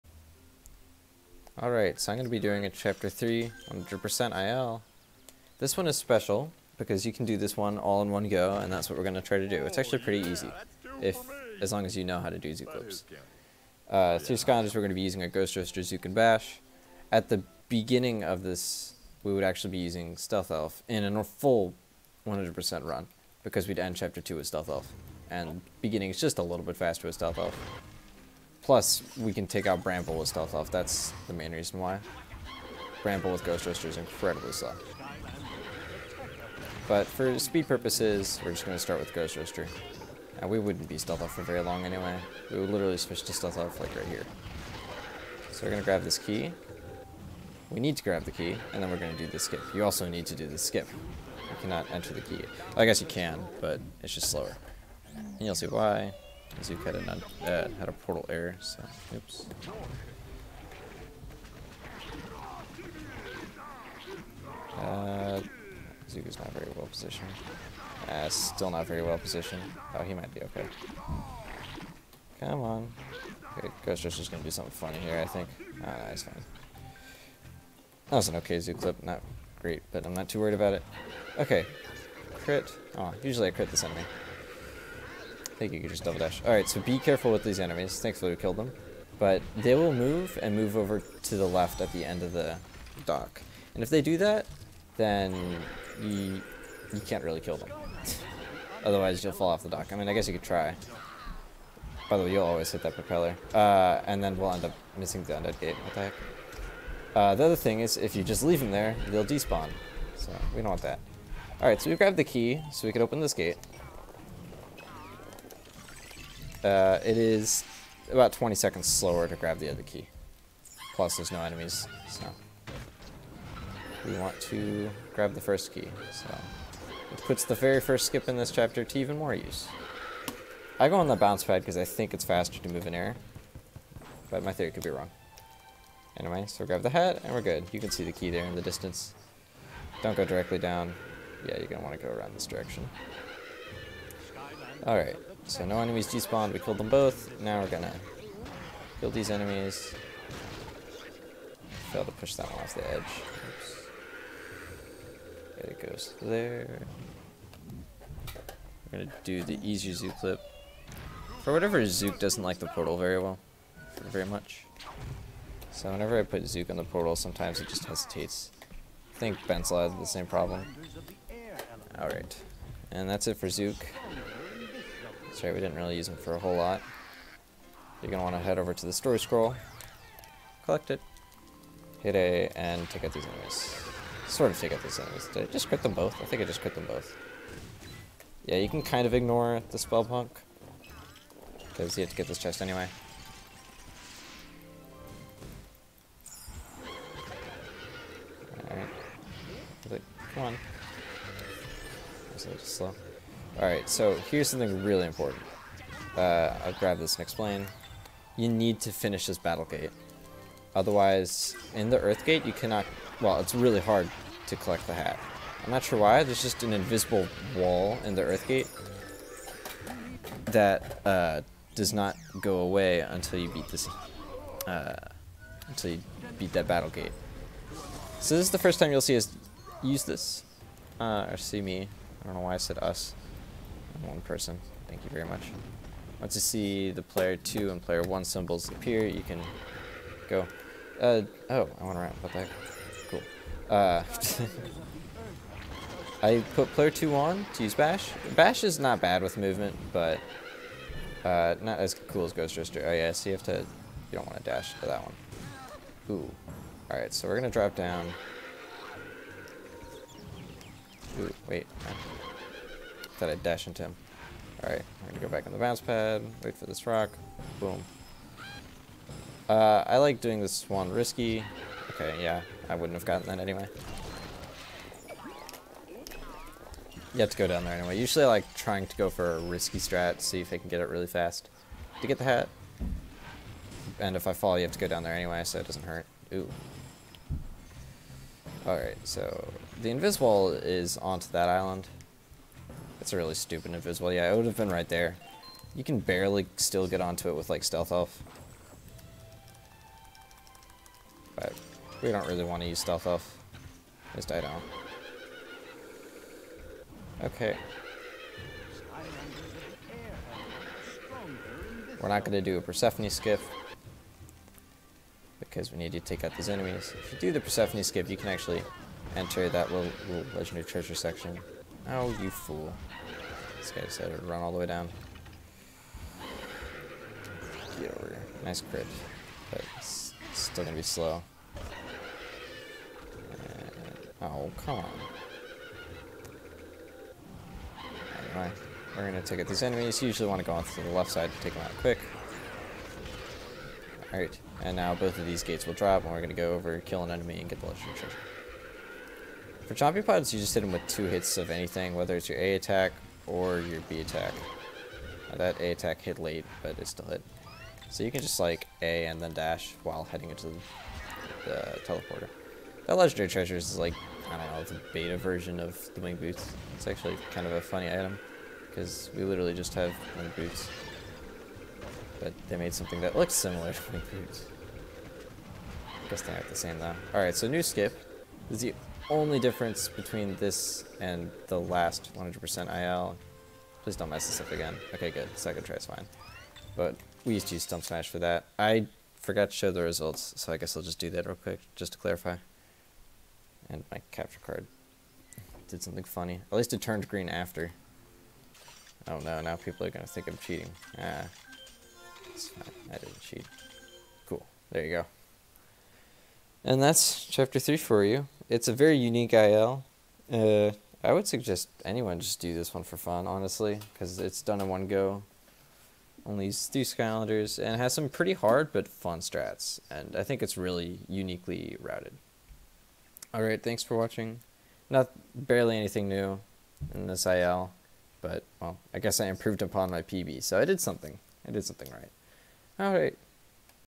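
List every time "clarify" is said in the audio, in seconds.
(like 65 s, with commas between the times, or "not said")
391 s.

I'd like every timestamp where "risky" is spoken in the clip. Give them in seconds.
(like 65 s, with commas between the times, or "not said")
270 s, 279 s.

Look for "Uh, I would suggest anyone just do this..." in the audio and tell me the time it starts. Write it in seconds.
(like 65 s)
410 s.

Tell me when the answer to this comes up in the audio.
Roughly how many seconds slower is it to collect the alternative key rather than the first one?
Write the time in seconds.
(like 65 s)
118 s.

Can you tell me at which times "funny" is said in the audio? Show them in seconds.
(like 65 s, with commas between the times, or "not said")
74 s, 367 s, 396 s.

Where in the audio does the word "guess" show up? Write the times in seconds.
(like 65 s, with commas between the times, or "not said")
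52 s, 100 s, 376 s, 390 s, 428 s.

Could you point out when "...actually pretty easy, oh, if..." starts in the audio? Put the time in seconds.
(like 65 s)
9 s.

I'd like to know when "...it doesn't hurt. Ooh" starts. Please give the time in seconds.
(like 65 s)
285 s.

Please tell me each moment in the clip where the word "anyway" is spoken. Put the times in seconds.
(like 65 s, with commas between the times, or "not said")
41 s, 136 s, 192 s, 273 s, 277 s, 285 s, 338 s.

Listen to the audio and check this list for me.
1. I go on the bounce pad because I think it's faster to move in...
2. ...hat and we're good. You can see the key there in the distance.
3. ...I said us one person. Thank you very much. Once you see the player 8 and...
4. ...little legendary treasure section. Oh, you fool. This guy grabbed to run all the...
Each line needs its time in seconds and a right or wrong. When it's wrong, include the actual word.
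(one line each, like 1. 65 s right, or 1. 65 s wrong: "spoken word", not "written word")
1. 130 s right
2. 136 s right
3. 232 s wrong: "2", not "8"
4. 320 s wrong: "decided", not "grabbed".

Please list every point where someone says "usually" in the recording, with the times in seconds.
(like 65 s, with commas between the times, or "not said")
83 s, 277 s, 340 s.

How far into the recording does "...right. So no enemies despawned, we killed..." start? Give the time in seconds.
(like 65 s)
144 s.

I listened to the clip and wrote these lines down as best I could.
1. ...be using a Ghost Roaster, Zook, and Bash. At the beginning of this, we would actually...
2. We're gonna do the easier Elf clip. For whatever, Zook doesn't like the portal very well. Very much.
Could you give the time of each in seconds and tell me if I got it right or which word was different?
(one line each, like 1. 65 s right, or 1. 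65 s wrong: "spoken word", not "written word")
1. 14 s right
2. 158 s wrong: "Zook", not "Elf".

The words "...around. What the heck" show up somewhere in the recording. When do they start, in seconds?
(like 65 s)
241 s.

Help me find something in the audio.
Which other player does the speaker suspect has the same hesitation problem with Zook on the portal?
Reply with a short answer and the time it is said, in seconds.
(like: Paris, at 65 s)
Bensla, at 169 s.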